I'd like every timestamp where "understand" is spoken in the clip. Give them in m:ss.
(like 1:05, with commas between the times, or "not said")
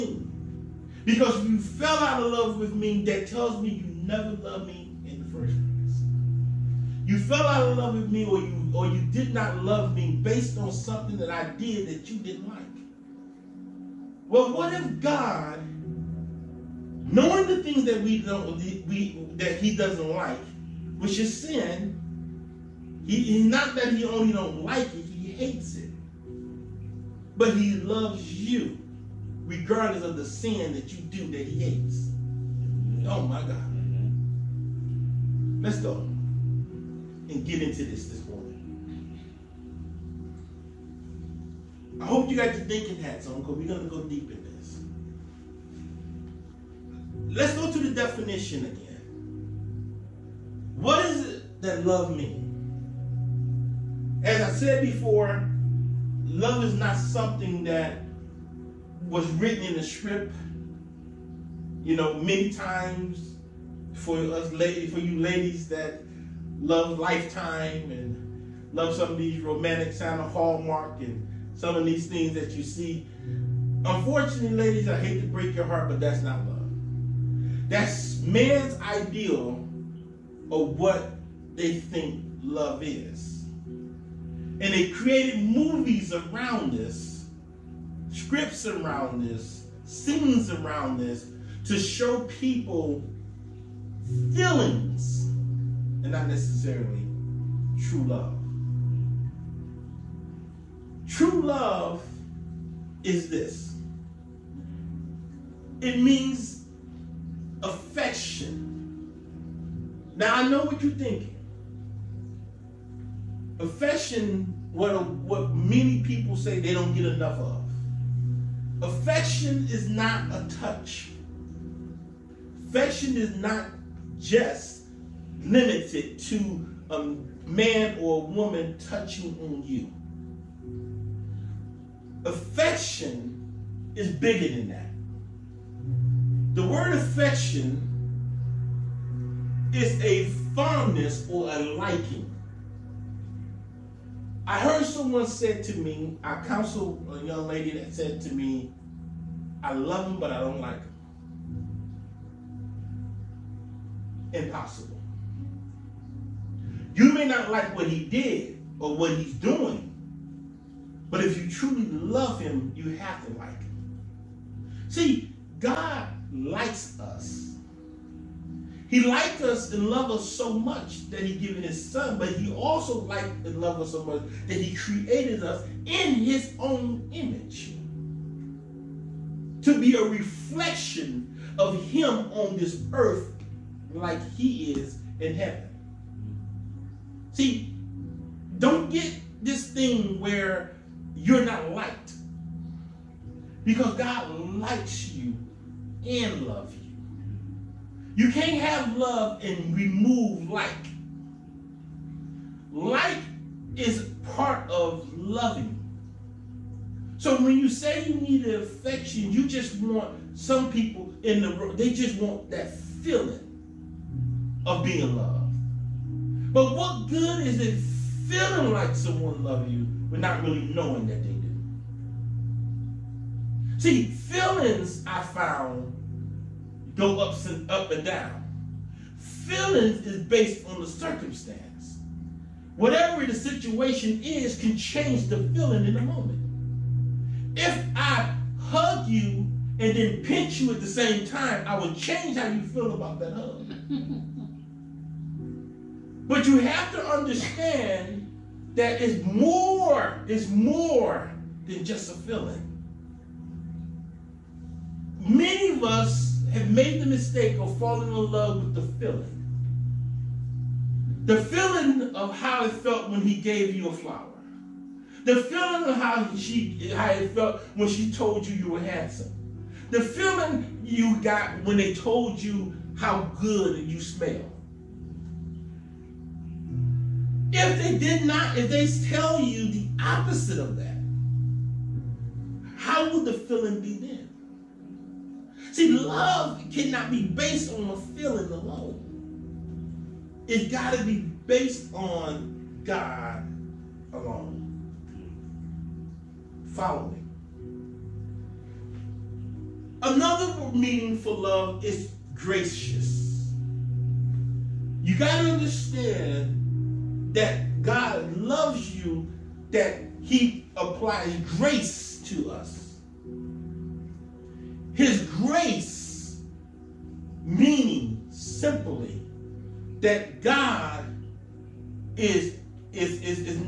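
4:07, 5:05.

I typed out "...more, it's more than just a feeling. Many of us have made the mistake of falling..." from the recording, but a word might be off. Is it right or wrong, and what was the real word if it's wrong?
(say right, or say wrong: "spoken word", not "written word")
right.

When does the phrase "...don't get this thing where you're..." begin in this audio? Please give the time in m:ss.
3:08.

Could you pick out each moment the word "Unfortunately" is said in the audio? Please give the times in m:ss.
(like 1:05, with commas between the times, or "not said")
1:13.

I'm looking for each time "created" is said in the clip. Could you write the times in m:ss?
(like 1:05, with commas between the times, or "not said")
1:24, 2:54.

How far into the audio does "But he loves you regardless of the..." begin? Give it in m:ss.
0:27.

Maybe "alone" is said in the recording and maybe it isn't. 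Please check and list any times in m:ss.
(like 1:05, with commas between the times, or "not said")
4:48, 4:54.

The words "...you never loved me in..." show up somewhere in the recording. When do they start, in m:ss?
0:03.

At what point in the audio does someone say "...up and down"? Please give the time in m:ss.
3:47.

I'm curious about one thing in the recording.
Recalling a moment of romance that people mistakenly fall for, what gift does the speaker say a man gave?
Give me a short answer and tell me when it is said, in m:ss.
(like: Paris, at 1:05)
A flower, at 4:23.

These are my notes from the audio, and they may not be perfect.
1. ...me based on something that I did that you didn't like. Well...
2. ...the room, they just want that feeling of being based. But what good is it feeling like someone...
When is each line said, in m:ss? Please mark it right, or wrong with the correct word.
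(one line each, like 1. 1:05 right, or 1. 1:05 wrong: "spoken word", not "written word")
1. 0:09 right
2. 3:31 wrong: "loved", not "based".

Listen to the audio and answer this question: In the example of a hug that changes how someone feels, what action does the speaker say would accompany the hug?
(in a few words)
Pinch.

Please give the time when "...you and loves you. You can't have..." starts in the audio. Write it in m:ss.
3:15.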